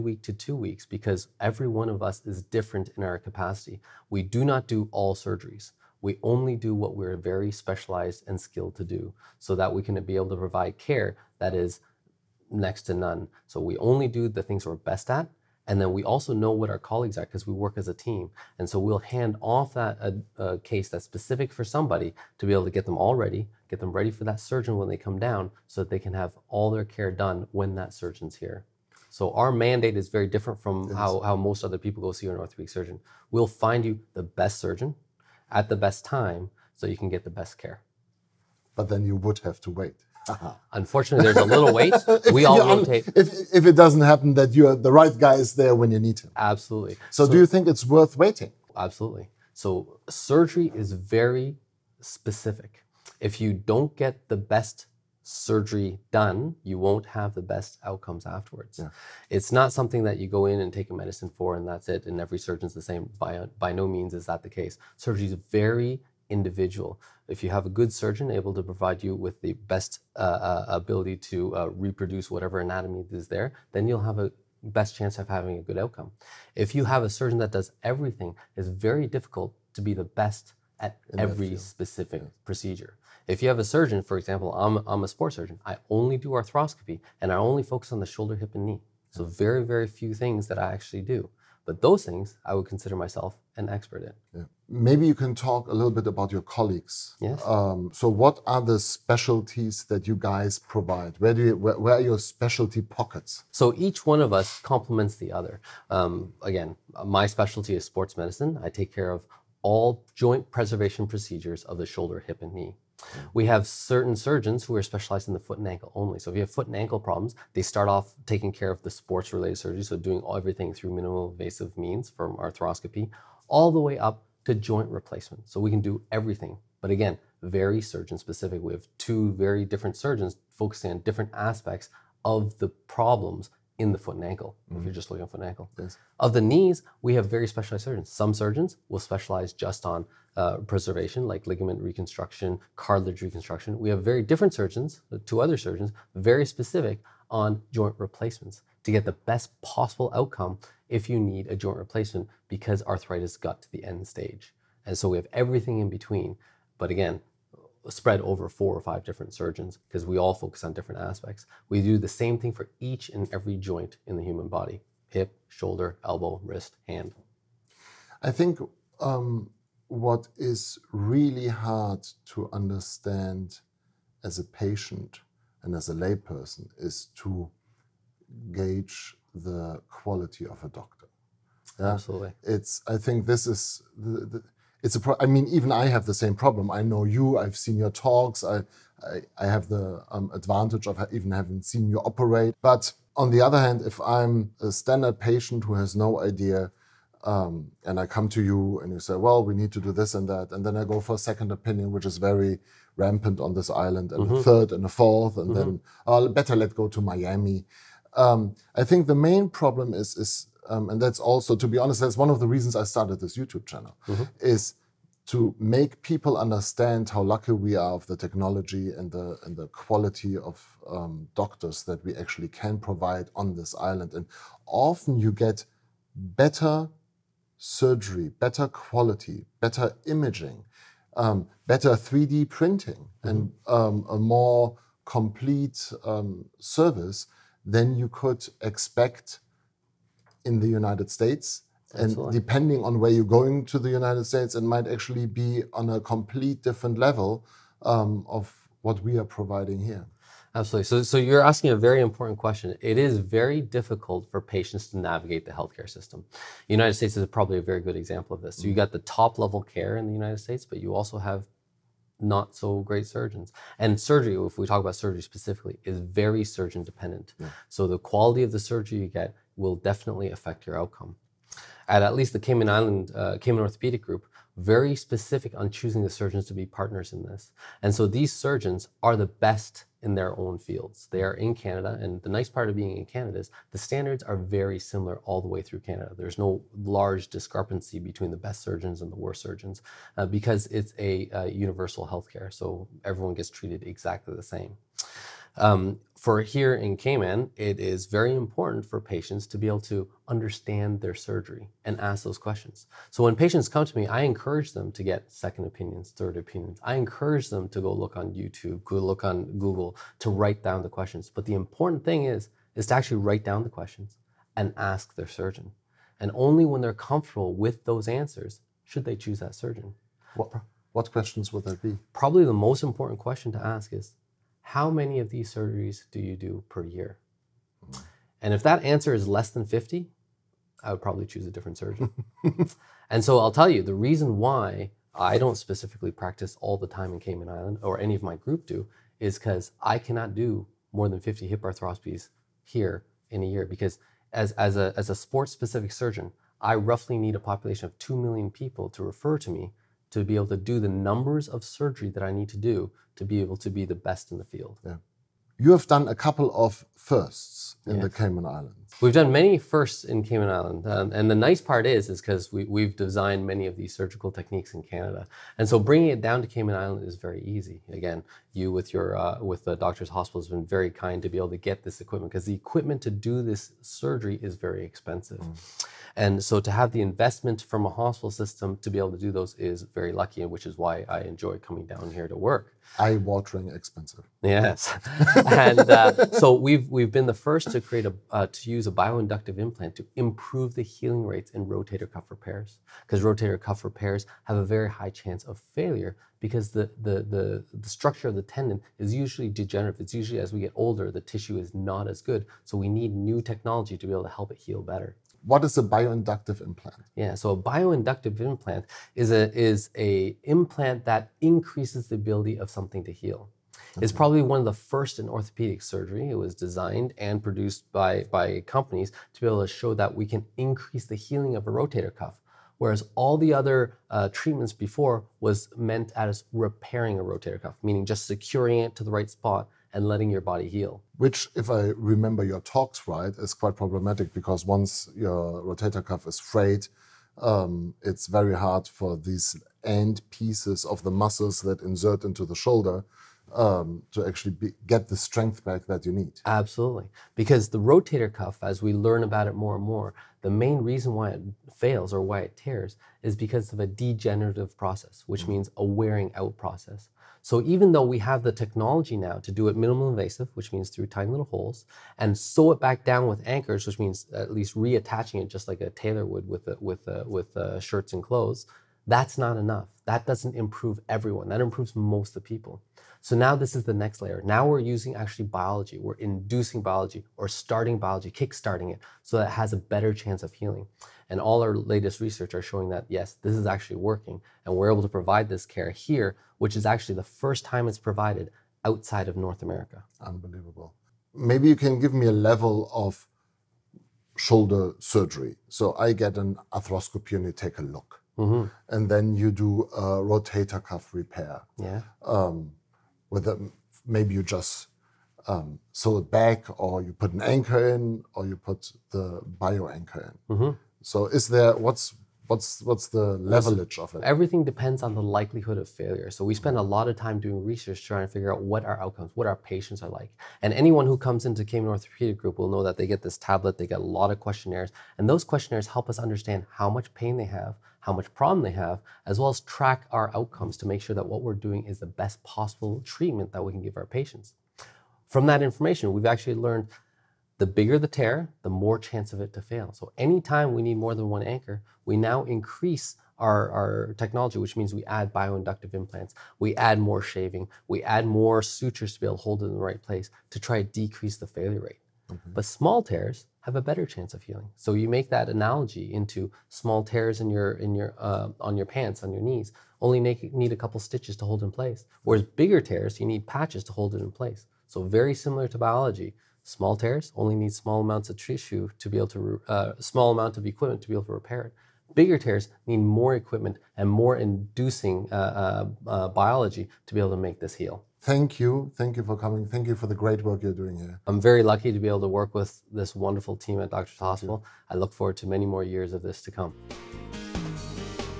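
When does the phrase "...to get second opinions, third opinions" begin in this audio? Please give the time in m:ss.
5:04.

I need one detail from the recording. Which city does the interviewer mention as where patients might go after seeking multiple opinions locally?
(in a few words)
Miami.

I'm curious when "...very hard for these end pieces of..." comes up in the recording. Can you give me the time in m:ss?
7:18.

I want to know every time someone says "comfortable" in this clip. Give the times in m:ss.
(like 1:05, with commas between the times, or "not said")
5:17.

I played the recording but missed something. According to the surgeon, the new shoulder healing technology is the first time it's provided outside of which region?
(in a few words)
North America.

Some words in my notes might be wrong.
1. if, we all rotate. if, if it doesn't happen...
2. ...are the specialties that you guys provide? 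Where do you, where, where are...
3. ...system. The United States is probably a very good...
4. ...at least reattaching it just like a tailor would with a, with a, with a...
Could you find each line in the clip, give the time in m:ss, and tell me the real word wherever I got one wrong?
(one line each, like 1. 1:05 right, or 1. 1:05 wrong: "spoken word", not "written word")
1. 0:42 right
2. 1:38 right
3. 4:15 right
4. 7:44 right.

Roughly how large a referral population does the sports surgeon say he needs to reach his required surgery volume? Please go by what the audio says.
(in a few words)
2 million people.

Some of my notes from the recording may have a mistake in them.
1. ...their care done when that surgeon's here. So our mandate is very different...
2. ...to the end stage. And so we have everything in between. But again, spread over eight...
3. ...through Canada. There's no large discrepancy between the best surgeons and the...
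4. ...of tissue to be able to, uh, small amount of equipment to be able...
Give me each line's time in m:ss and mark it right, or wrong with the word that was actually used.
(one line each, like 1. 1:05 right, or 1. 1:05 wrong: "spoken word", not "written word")
1. 0:26 right
2. 2:33 wrong: "four", not "eight"
3. 4:45 right
4. 9:28 right.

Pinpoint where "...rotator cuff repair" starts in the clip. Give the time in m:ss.
8:20.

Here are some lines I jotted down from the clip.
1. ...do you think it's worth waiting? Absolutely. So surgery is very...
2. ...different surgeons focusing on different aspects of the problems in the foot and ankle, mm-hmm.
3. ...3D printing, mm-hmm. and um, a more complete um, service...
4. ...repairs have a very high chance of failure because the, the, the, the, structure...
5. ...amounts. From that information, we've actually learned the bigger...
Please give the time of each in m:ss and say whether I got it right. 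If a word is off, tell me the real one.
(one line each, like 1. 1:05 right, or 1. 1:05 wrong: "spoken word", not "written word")
1. 0:47 right
2. 2:09 right
3. 3:51 right
4. 6:33 right
5. 8:54 wrong: "patients", not "amounts".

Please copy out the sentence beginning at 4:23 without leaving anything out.
And surgery, if we talk about surgery specifically, is very surgeon dependent.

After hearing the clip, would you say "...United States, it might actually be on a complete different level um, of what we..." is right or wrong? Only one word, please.
right.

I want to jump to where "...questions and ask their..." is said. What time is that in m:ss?
5:13.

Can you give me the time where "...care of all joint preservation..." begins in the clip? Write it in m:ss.
1:48.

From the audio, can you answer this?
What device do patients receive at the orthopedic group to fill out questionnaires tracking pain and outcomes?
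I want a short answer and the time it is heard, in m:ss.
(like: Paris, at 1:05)
tablet, at 8:43.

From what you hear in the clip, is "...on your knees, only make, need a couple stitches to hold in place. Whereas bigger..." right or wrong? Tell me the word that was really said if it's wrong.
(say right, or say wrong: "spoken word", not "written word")
right.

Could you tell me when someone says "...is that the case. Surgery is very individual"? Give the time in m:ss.
1:04.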